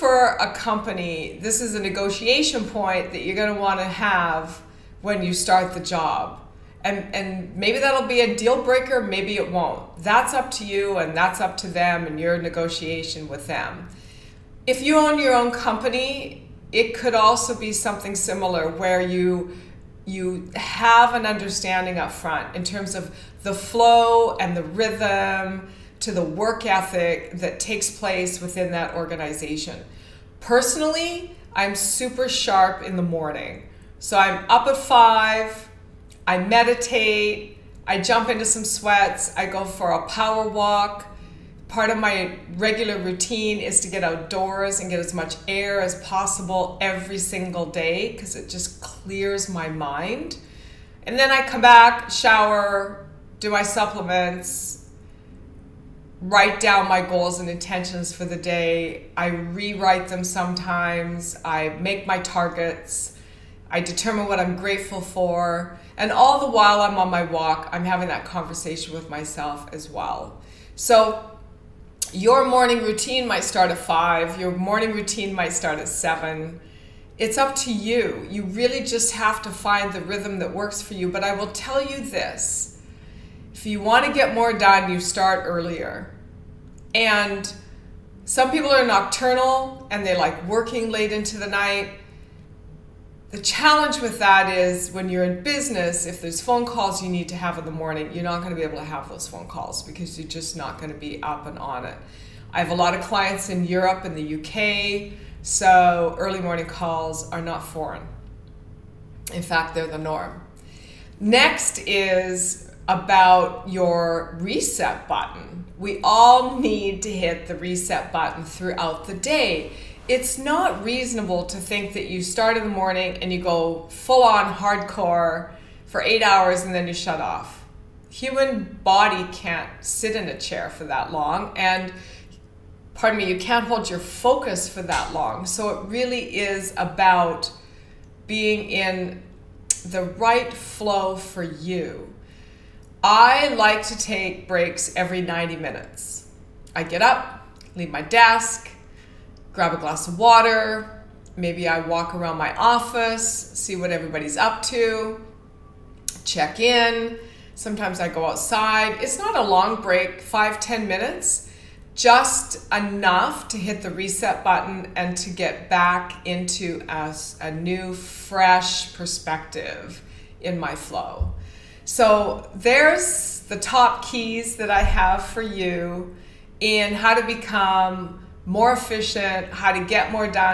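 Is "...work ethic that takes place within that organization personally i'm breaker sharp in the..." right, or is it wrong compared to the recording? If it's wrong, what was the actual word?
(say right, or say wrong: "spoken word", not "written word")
wrong: "super", not "breaker".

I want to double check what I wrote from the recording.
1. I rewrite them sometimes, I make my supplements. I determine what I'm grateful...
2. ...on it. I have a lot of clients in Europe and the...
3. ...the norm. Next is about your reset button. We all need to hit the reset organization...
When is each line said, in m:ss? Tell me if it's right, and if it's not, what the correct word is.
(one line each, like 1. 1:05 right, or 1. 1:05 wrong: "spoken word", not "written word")
1. 0:59 wrong: "targets", not "supplements"
2. 1:41 right
3. 1:49 wrong: "button", not "organization".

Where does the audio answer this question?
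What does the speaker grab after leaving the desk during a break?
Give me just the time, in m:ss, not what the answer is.
2:29.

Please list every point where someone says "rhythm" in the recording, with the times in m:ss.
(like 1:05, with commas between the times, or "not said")
0:24, 1:20.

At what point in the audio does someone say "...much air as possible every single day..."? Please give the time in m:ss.
0:45.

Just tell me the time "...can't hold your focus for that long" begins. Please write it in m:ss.
2:13.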